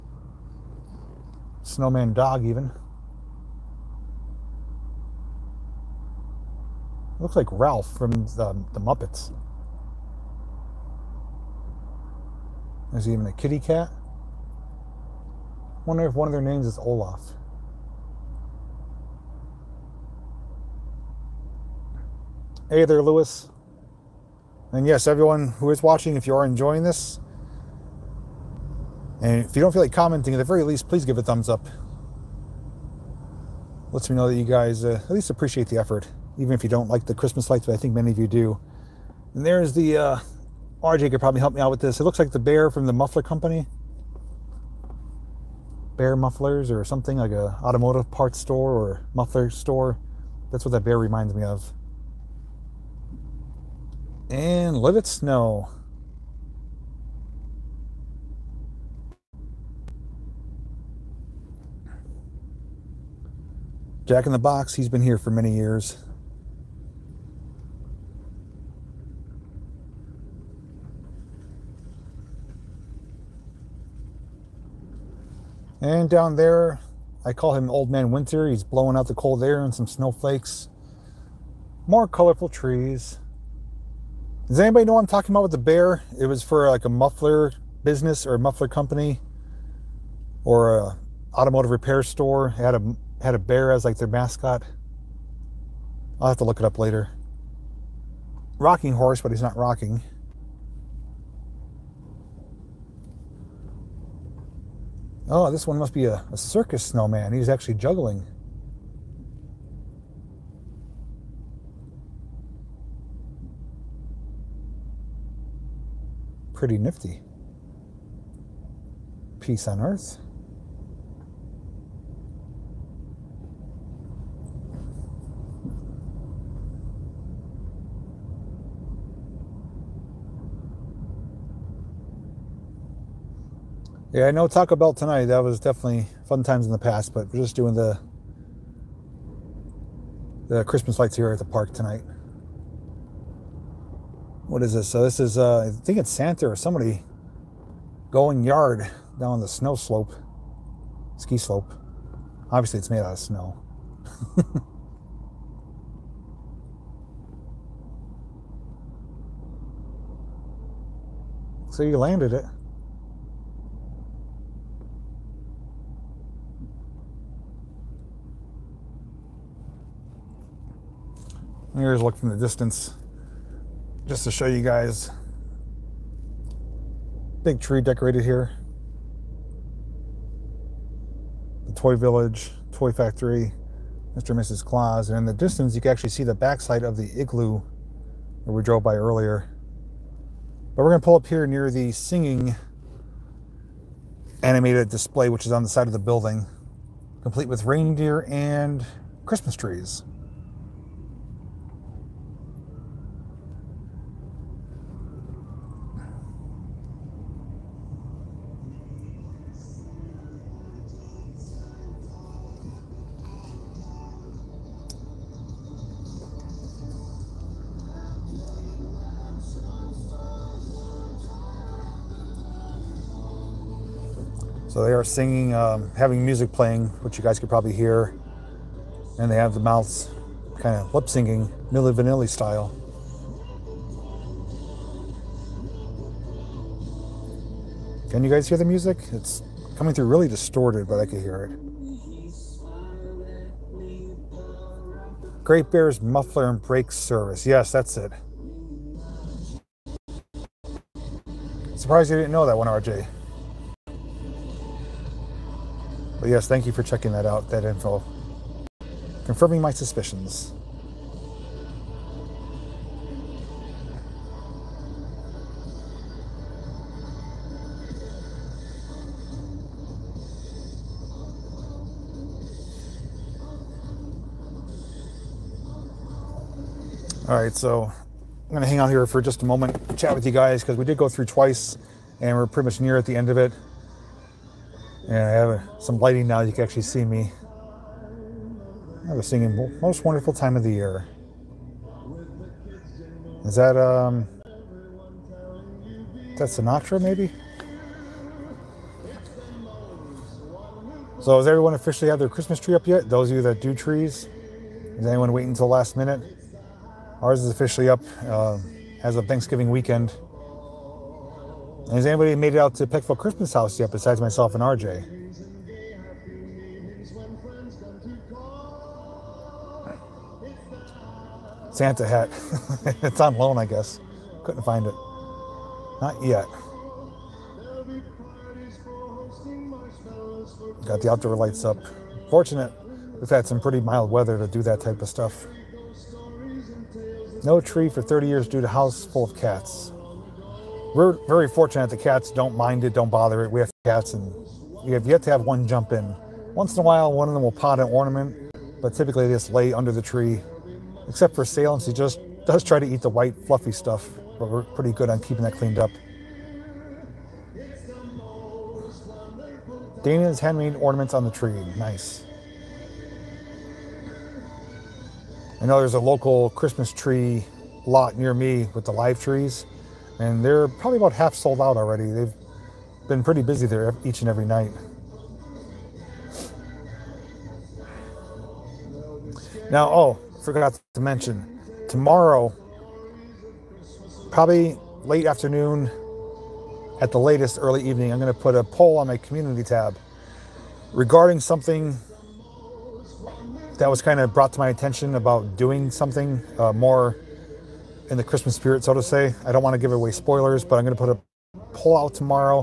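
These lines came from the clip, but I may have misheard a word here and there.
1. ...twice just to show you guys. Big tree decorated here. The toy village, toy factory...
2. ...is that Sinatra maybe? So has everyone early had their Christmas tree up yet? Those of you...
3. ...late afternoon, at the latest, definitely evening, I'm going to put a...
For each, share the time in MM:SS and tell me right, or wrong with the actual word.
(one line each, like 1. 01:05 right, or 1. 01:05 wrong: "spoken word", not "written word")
1. 02:52 wrong: "distance", not "twice"
2. 04:56 wrong: "officially", not "early"
3. 06:25 wrong: "early", not "definitely".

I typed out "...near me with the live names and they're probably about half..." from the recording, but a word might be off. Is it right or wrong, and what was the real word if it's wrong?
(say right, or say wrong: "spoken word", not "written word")
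wrong: "trees", not "names".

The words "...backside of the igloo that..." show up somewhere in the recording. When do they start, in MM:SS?
03:06.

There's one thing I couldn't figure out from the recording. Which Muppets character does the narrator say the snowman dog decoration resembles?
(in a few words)
Ralph.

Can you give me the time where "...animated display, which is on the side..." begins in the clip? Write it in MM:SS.
03:14.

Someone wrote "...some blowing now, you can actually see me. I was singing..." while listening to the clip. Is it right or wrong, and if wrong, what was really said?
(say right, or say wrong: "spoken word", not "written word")
wrong: "lighting", not "blowing".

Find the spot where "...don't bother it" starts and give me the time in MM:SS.
05:42.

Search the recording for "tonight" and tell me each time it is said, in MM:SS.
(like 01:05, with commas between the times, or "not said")
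02:14, 02:21.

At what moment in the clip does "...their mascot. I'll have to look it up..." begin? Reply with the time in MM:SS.
01:33.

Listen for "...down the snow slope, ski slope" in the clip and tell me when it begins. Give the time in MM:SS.
02:29.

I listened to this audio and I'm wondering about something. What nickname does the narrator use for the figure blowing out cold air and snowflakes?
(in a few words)
Old Man Winter.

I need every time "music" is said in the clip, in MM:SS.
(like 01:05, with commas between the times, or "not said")
03:46, 03:58.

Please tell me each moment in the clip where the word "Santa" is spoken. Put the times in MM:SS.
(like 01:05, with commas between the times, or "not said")
02:26, 05:21.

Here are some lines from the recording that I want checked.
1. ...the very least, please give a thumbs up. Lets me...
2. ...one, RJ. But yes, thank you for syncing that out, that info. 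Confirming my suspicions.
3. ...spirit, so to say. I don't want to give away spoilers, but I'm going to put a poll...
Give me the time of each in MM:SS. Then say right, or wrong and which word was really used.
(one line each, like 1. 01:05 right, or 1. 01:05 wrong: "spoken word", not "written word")
1. 00:30 right
2. 04:12 wrong: "checking", not "syncing"
3. 06:38 right.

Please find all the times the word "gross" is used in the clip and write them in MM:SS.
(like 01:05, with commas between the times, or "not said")
not said.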